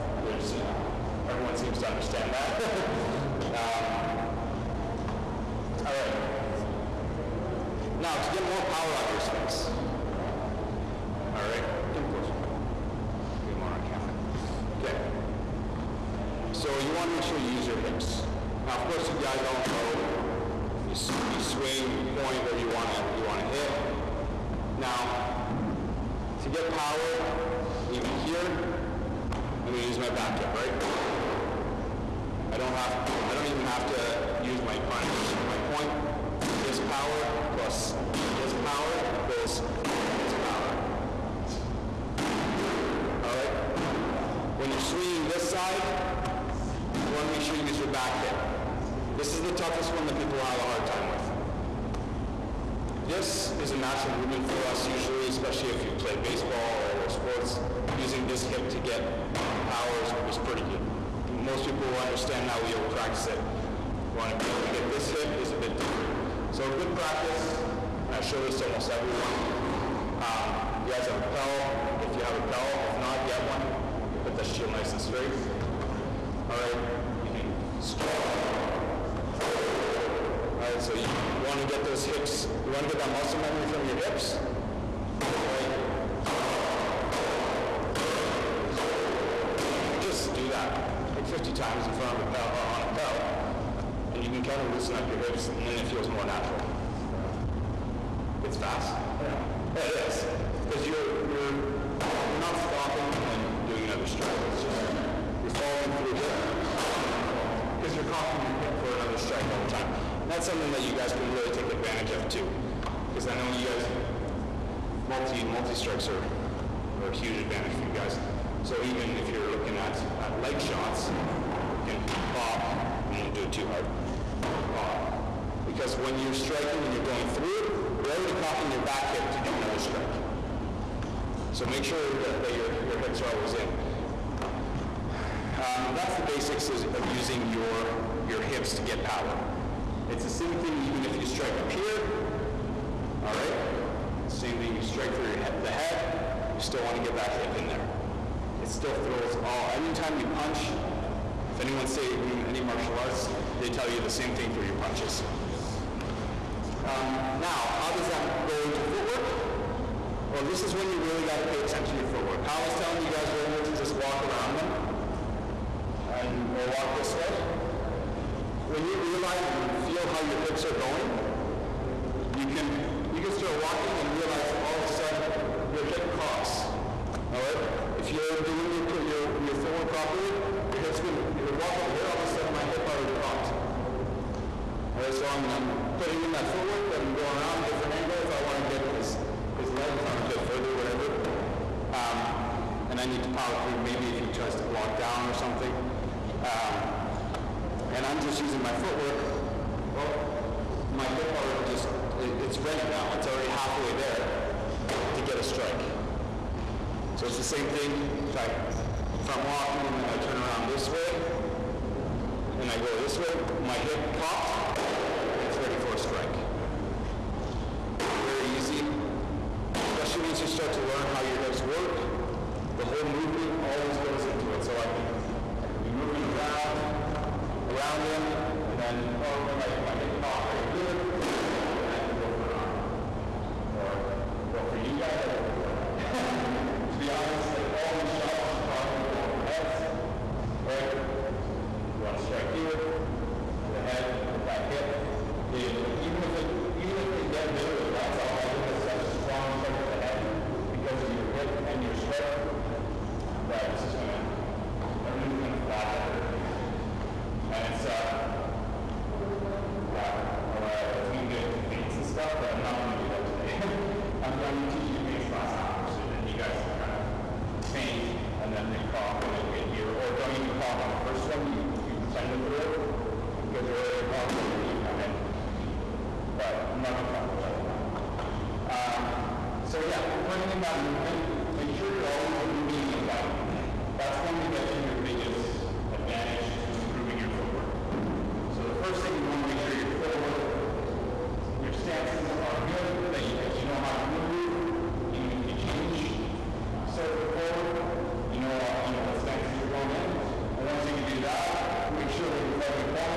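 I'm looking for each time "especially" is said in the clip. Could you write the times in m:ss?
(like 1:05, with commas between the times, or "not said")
0:55, 3:39.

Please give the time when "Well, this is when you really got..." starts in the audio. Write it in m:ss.
2:40.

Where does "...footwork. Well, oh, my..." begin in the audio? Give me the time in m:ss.
3:18.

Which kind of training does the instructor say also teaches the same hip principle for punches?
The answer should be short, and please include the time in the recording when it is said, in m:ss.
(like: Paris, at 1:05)
martial arts, at 2:32.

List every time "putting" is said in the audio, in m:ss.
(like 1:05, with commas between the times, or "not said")
3:05, 4:40.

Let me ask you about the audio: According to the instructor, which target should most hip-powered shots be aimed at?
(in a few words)
heads.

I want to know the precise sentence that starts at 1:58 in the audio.
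So even if you're looking at, at leg shots, you can pop, I won't do it too hard, pop.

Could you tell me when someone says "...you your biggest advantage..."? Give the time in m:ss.
4:44.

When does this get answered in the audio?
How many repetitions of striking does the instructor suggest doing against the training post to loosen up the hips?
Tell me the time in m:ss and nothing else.
1:31.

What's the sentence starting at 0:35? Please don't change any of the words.
My point, this power plus this power equals this power.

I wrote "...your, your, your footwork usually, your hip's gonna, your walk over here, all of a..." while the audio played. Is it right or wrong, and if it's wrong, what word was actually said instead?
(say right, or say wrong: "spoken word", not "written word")
wrong: "properly", not "usually".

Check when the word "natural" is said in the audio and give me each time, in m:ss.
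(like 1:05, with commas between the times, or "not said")
0:53, 1:36.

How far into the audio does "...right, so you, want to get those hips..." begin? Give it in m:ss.
1:20.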